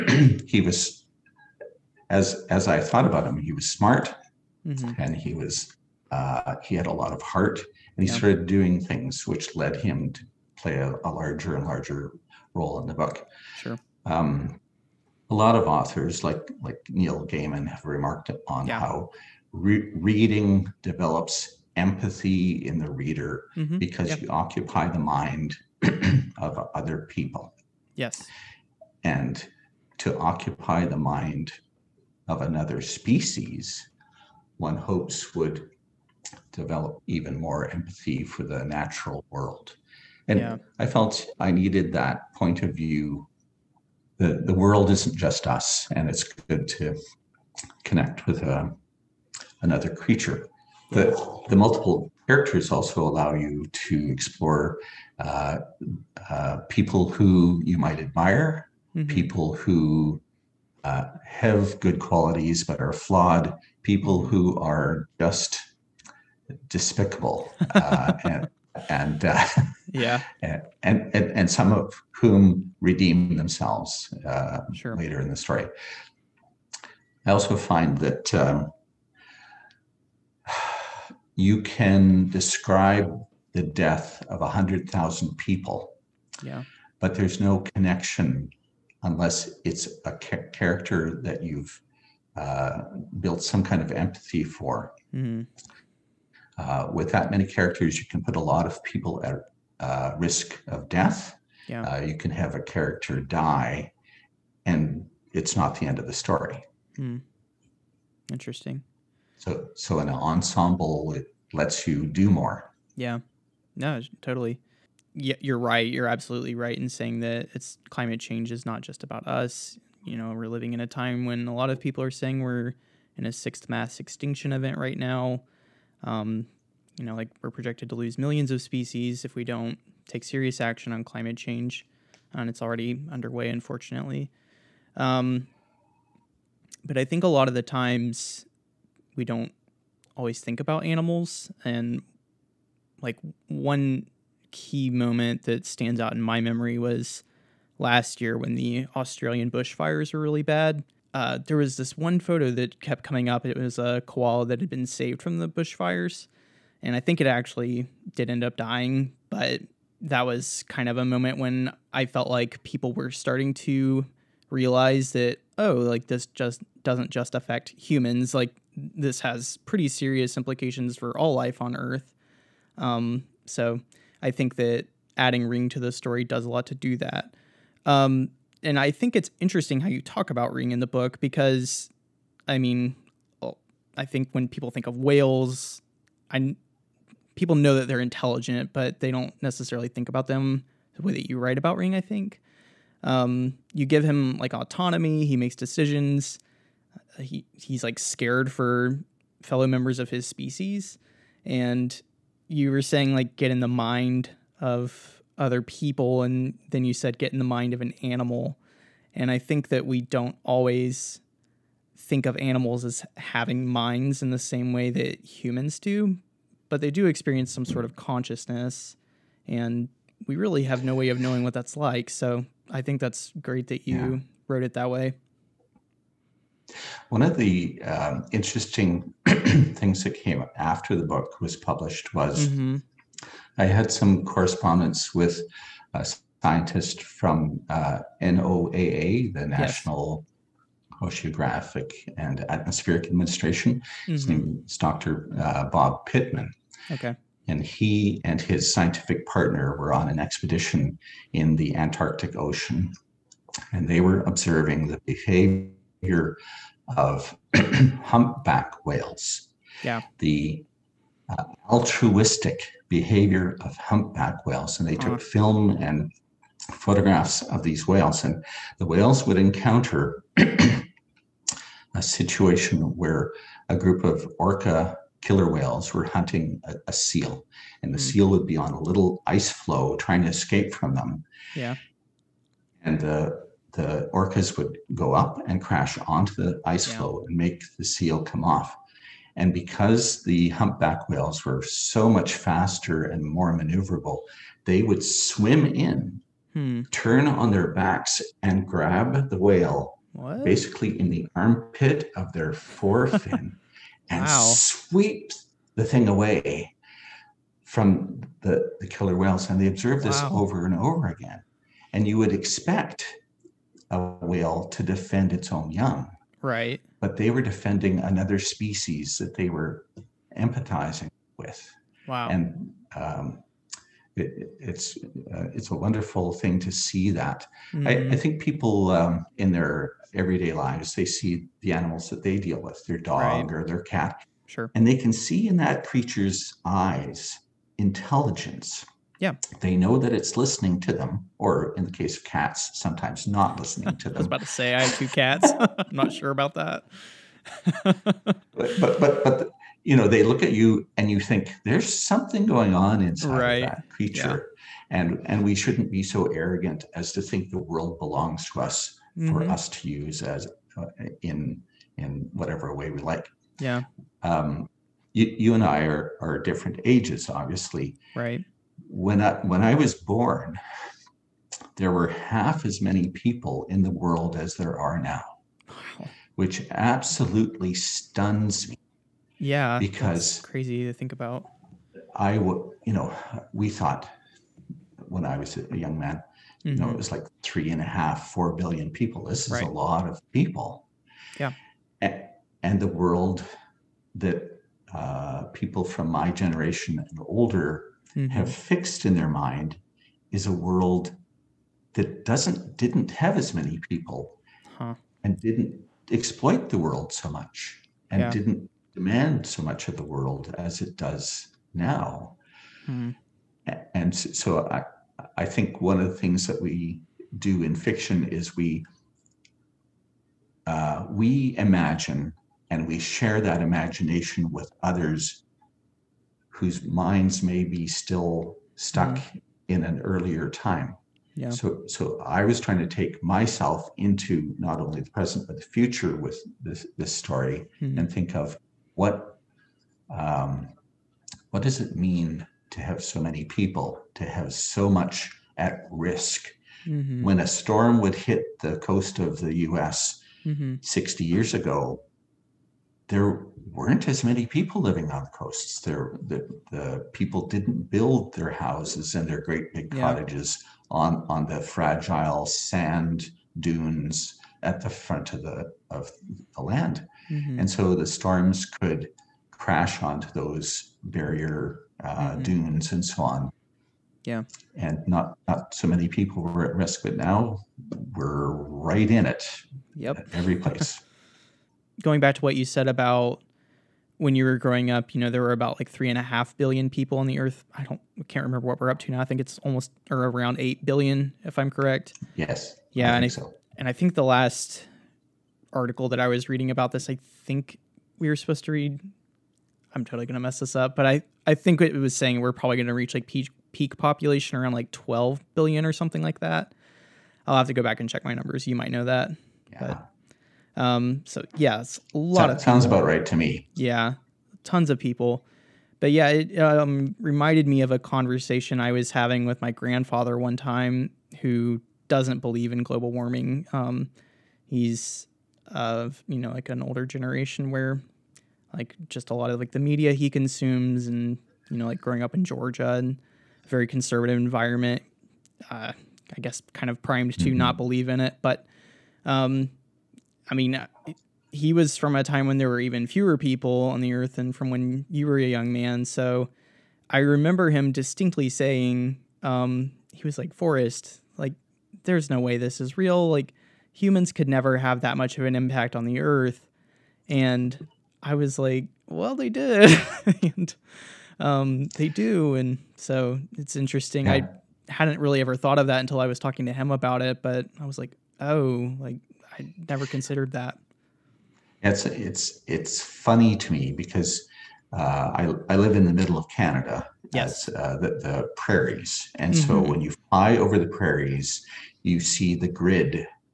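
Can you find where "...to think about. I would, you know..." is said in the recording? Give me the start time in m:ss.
6:20.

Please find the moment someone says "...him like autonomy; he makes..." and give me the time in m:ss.
3:14.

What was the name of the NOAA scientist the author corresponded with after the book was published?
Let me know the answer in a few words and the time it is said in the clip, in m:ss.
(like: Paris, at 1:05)
Bob Pittman, at 4:05.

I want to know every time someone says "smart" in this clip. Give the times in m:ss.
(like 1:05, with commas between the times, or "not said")
0:03.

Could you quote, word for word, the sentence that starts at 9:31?
It's it's it's funny to me because uh, I I live in the middle of Canada.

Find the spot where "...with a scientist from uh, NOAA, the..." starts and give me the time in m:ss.
3:55.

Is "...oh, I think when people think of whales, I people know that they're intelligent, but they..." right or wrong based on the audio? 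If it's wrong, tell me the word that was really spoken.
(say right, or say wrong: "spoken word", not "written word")
right.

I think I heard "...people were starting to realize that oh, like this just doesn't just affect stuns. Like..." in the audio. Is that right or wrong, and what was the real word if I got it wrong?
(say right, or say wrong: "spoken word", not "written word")
wrong: "humans", not "stuns".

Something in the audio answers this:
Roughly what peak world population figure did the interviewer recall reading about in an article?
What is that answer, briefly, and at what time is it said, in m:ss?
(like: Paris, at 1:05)
12 billion, at 8:24.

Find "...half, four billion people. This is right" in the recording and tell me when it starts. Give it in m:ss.
6:27.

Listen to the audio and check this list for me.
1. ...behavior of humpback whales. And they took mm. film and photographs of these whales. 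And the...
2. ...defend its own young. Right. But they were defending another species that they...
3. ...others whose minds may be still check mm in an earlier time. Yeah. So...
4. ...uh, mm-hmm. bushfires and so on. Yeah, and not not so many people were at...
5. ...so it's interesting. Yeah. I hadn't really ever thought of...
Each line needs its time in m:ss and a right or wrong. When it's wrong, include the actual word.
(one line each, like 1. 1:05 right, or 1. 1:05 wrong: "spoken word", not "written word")
1. 4:22 right
2. 5:14 right
3. 7:04 wrong: "stuck", not "check"
4. 7:52 wrong: "dunes", not "bushfires"
5. 9:22 right.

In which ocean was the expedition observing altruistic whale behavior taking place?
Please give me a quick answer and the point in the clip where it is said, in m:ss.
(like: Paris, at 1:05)
Antarctic Ocean, at 4:11.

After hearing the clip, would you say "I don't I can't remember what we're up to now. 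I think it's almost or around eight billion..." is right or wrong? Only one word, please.
right.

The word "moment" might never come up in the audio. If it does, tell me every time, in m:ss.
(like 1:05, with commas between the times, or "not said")
2:24, 2:41.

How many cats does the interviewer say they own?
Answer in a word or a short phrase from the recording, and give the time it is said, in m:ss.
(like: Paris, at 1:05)
2, at 5:44.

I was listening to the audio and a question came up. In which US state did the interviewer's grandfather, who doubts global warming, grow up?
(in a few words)
Georgia.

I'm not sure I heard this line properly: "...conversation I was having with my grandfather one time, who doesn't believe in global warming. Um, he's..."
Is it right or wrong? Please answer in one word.
right.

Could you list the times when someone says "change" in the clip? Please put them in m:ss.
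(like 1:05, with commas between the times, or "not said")
1:58, 2:11.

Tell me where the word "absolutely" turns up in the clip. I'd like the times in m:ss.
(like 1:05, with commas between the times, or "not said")
1:56, 6:16.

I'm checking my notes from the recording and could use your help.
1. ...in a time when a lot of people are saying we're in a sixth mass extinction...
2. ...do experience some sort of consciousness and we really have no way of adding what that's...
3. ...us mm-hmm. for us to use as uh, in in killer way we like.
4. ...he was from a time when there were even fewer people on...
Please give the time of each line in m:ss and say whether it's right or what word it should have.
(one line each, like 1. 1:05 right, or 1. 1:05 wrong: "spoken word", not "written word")
1. 2:00 right
2. 3:36 wrong: "knowing", not "adding"
3. 5:58 wrong: "whatever", not "killer"
4. 9:01 right.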